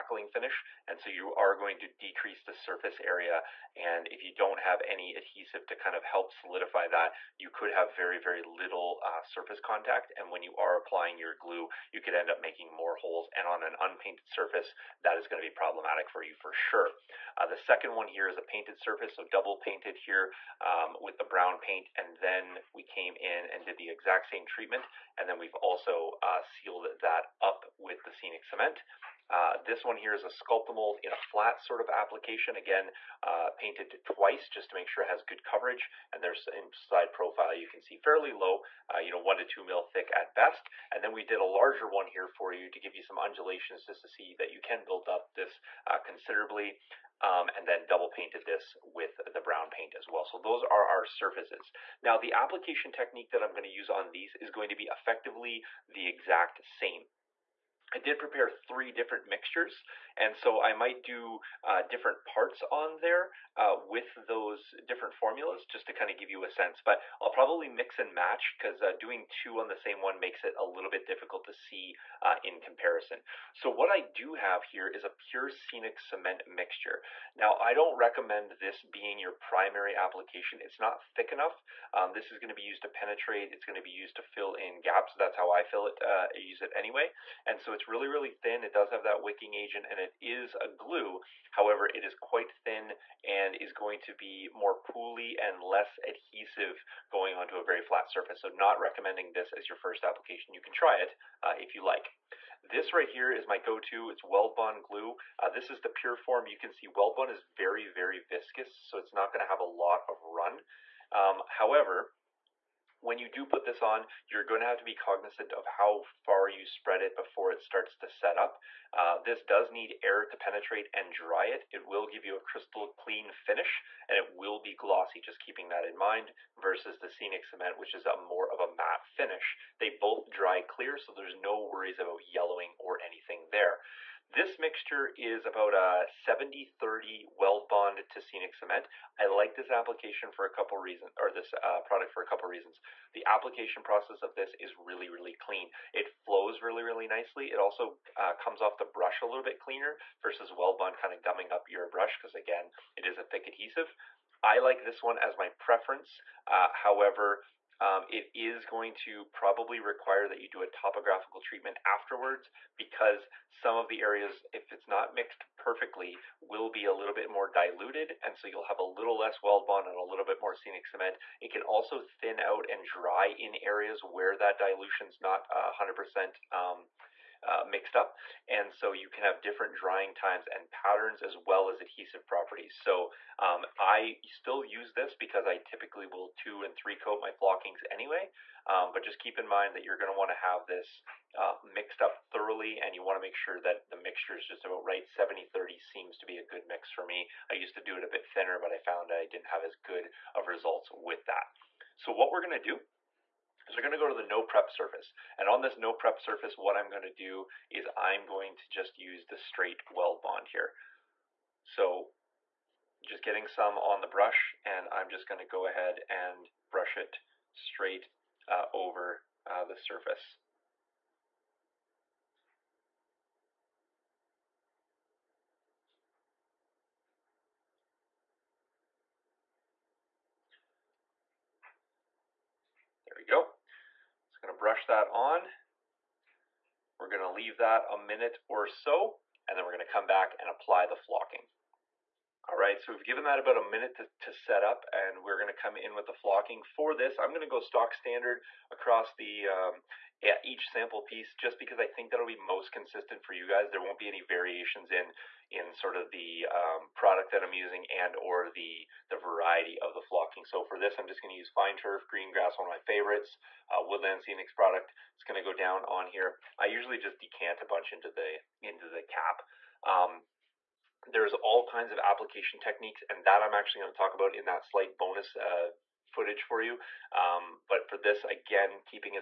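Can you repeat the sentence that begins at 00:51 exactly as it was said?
Now the application technique that I'm going to use on these is going to be effectively the exact same.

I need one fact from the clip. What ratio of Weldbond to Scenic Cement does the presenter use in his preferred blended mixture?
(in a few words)
70-30.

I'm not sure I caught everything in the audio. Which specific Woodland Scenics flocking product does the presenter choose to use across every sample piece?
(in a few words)
Fine turf, green grass.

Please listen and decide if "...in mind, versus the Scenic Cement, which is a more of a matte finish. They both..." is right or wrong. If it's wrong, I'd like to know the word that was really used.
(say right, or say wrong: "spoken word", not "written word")
right.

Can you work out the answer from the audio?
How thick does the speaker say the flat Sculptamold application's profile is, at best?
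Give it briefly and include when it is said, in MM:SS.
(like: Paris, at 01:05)
1 to 2 mil, at 00:39.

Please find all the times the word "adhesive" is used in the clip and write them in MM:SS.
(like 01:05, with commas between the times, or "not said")
00:05, 01:36, 02:33, 03:01.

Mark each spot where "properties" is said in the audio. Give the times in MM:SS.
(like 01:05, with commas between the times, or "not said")
03:02.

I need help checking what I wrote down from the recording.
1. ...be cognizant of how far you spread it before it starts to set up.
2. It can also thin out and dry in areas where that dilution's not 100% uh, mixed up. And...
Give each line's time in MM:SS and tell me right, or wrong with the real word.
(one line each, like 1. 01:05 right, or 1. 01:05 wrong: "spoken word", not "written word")
1. 01:54 right
2. 02:51 right.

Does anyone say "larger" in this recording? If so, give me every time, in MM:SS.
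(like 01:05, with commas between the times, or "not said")
00:41.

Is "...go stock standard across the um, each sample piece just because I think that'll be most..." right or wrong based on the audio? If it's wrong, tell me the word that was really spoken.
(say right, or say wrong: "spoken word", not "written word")
right.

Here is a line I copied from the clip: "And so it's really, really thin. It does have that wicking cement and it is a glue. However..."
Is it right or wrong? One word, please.
wrong.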